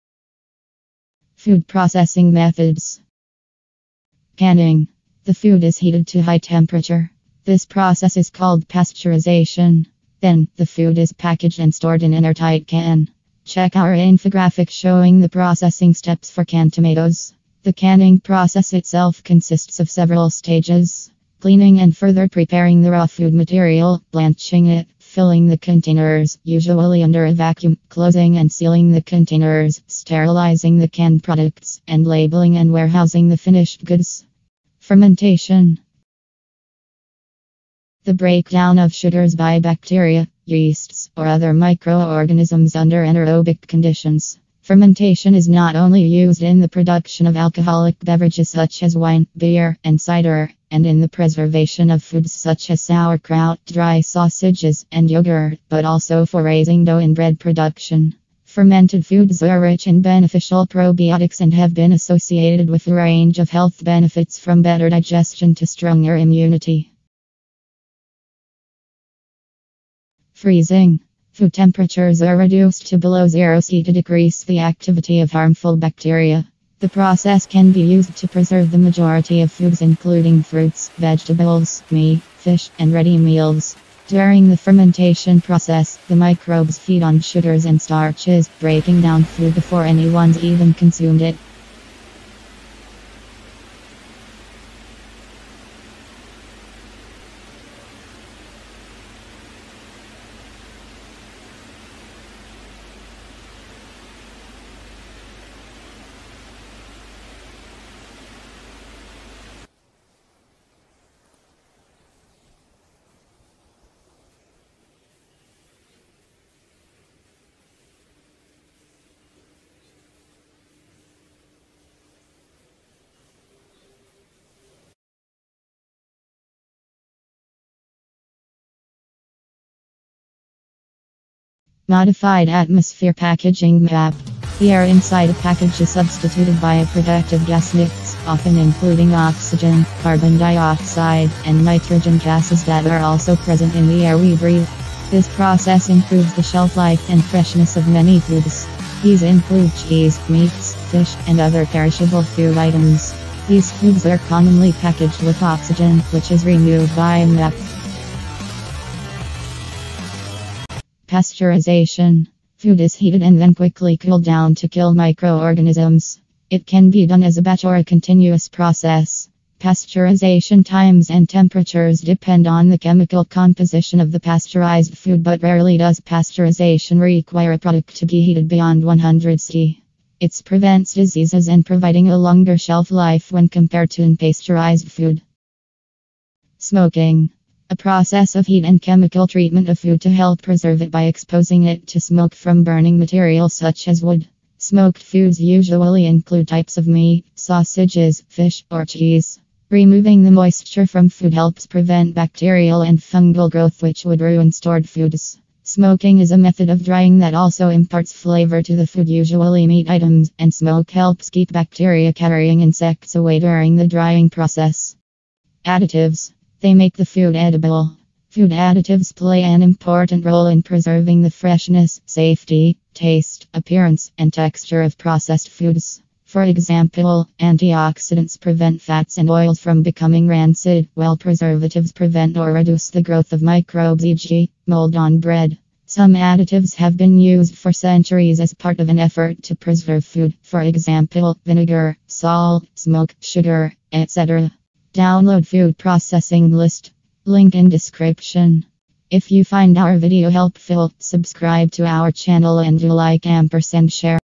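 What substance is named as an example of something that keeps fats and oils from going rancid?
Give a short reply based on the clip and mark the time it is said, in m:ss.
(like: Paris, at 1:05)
Antioxidants, at 3:47.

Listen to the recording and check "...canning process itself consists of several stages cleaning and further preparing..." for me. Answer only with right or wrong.
right.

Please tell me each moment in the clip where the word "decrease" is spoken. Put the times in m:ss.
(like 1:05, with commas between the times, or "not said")
1:13.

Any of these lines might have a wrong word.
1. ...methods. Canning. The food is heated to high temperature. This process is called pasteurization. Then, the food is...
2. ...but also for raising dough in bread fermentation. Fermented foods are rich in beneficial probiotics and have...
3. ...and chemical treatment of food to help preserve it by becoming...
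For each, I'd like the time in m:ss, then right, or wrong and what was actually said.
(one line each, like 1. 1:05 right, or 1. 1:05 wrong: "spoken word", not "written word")
1. 0:02 right
2. 0:55 wrong: "production", not "fermentation"
3. 3:08 wrong: "exposing", not "becoming".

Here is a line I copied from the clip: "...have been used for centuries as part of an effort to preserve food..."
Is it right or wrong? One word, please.
right.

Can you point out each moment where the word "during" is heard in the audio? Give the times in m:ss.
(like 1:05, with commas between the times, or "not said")
1:24, 3:33.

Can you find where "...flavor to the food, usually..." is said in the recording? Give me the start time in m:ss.
3:28.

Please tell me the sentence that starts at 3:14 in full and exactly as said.
Smoked foods usually include types of meat, sausages, fish, or cheese.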